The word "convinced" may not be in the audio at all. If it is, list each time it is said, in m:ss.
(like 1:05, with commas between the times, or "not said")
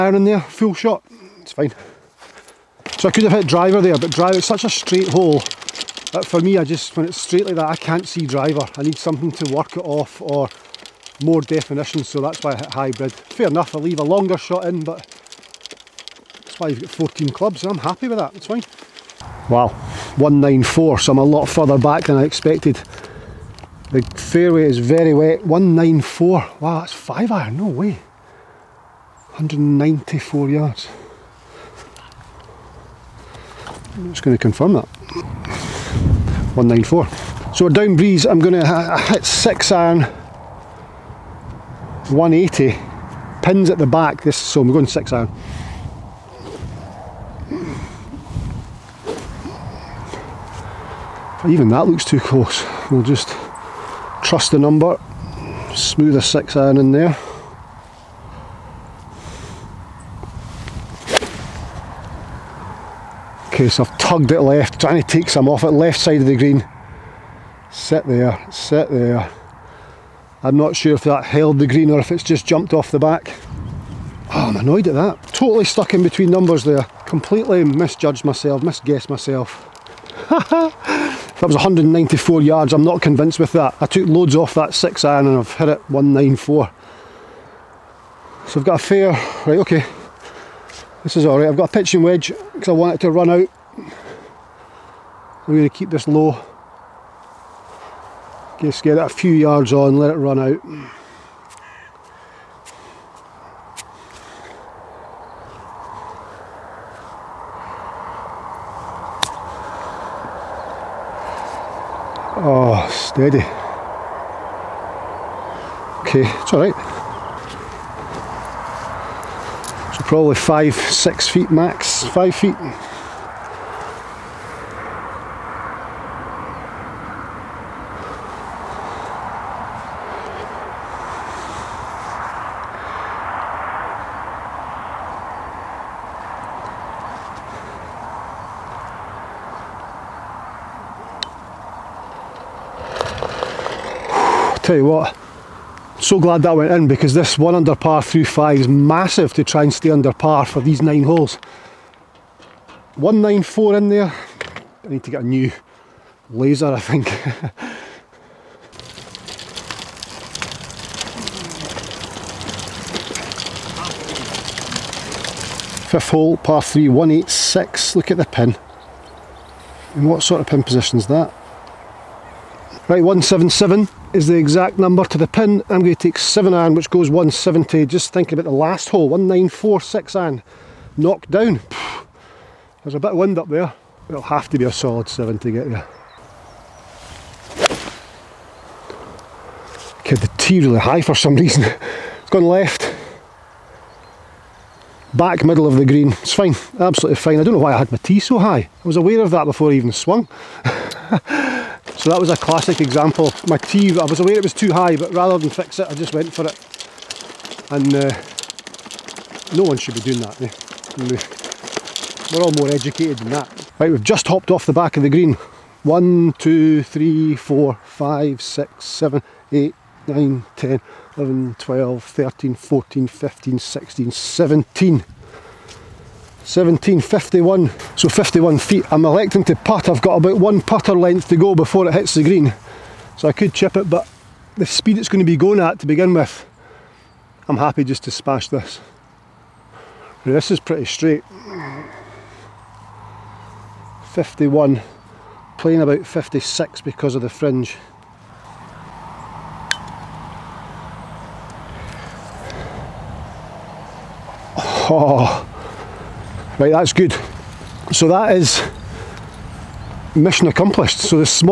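1:23.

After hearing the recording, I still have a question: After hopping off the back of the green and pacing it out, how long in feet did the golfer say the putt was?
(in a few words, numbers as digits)
51 feet.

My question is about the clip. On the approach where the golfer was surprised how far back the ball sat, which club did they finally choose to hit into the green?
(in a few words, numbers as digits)
6 iron.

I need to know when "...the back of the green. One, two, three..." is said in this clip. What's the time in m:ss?
3:34.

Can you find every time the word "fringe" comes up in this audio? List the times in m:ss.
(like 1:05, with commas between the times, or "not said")
4:07.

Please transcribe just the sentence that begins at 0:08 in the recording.
I need something to work it off or more definition, so that's why I hit hybrid.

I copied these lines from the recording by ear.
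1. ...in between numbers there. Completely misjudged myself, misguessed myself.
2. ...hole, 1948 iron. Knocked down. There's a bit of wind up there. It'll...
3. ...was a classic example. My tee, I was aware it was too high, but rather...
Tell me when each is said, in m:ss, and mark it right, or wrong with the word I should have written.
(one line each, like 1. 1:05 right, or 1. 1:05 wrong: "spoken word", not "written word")
1. 1:15 right
2. 2:58 wrong: "1946", not "1948"
3. 3:22 right.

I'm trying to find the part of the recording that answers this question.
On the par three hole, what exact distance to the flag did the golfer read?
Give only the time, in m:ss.
2:53.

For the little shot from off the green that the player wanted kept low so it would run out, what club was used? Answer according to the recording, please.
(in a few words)
Pitching wedge.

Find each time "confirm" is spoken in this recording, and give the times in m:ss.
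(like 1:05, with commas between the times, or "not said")
0:34.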